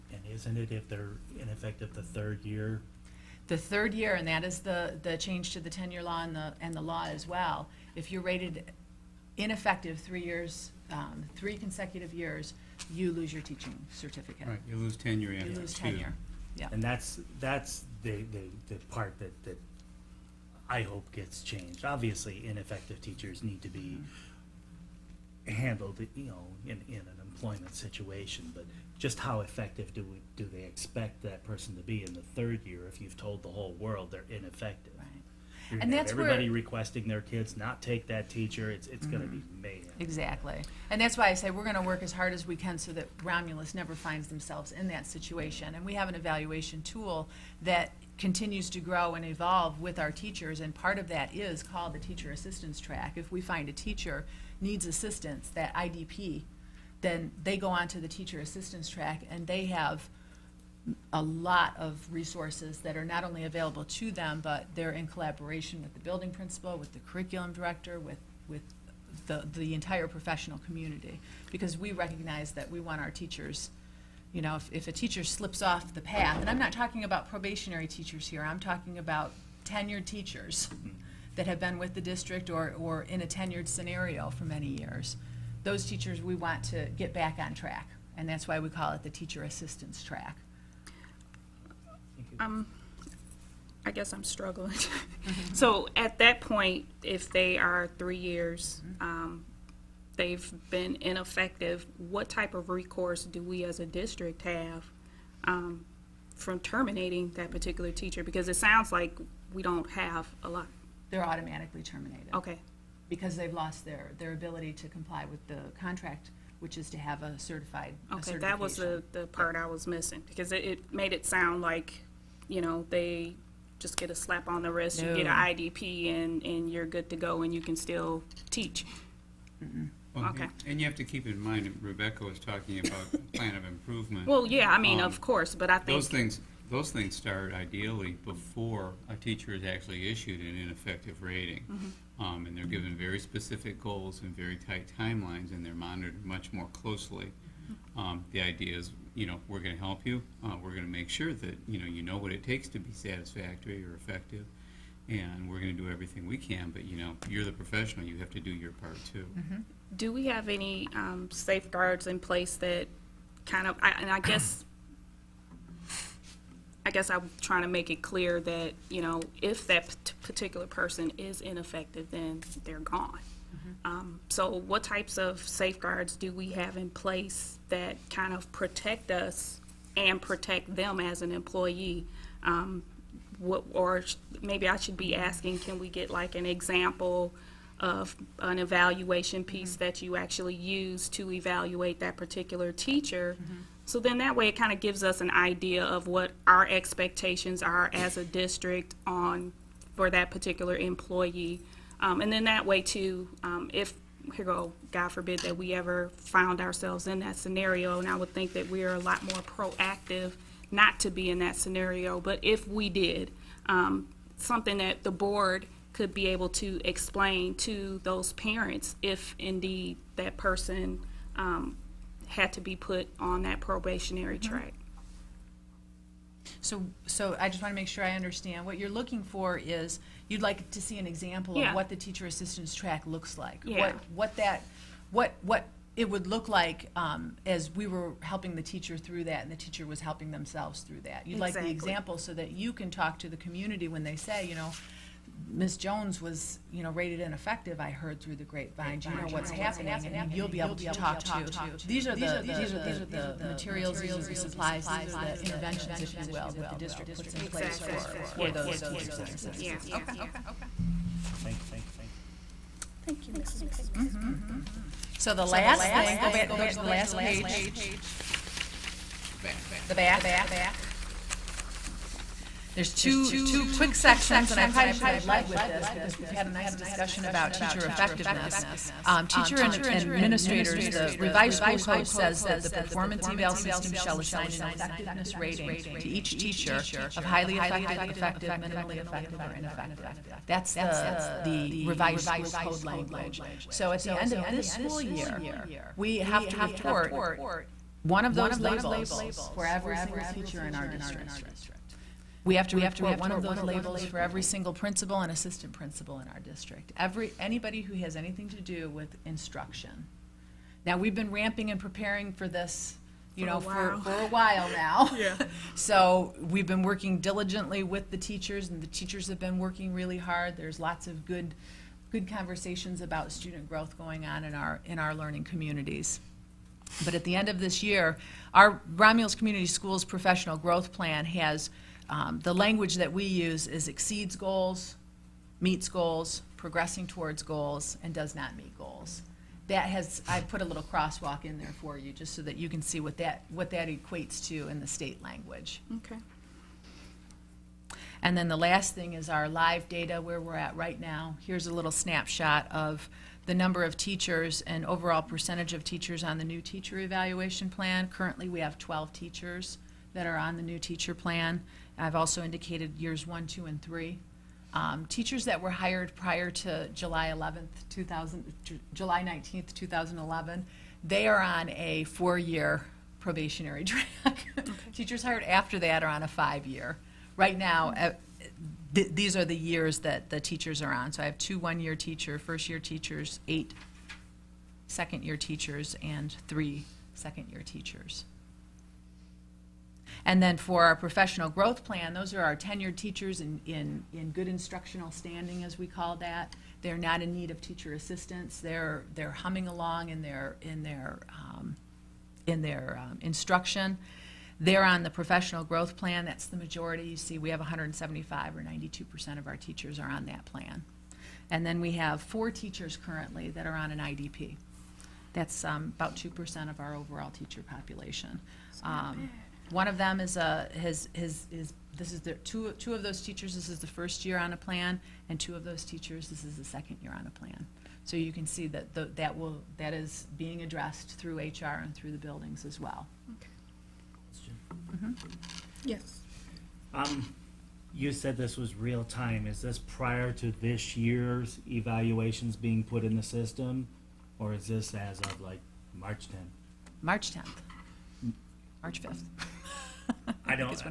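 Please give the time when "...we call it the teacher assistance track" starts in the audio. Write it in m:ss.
1:28.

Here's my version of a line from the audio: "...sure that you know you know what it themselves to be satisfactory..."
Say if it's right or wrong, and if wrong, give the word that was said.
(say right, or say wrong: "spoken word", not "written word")
wrong: "takes", not "themselves".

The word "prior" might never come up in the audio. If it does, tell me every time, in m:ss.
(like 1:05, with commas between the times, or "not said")
6:06, 7:19.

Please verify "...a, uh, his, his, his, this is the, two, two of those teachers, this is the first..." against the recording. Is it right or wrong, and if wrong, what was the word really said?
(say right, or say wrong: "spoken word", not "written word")
right.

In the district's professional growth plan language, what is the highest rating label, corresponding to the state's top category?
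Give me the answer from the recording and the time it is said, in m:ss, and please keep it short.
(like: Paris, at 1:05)
Exceeds goals, at 5:33.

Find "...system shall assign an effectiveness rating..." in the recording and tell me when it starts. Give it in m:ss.
4:43.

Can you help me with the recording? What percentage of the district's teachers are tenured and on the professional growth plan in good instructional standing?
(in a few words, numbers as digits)
92%.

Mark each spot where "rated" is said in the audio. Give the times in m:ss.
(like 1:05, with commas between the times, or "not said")
0:08, 4:06.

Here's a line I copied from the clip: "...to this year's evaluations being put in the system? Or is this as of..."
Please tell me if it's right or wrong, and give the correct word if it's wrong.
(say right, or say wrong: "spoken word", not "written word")
right.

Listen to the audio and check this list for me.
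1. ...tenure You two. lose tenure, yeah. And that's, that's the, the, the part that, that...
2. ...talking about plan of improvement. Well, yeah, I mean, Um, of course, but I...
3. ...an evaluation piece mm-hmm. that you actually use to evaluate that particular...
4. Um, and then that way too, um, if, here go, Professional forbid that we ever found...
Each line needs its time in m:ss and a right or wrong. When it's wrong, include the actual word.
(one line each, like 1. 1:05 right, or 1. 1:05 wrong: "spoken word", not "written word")
1. 0:14 right
2. 2:12 right
3. 3:08 right
4. 3:22 wrong: "God", not "Professional".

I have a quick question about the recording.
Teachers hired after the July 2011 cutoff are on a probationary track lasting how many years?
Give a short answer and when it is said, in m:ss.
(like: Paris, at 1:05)
5, at 6:16.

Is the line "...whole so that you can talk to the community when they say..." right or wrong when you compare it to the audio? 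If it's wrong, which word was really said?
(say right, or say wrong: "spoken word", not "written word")
wrong: "example", not "whole".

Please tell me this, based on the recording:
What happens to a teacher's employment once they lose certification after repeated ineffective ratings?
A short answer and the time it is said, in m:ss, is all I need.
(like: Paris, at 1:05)
Automatically terminated, at 1:51.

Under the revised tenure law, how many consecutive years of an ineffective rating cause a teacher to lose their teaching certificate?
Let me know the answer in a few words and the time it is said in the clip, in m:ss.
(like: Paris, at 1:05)
3, at 0:11.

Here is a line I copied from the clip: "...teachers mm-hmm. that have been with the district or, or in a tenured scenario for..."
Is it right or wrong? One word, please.
right.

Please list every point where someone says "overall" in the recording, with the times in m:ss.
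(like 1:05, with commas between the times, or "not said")
5:54, 6:56.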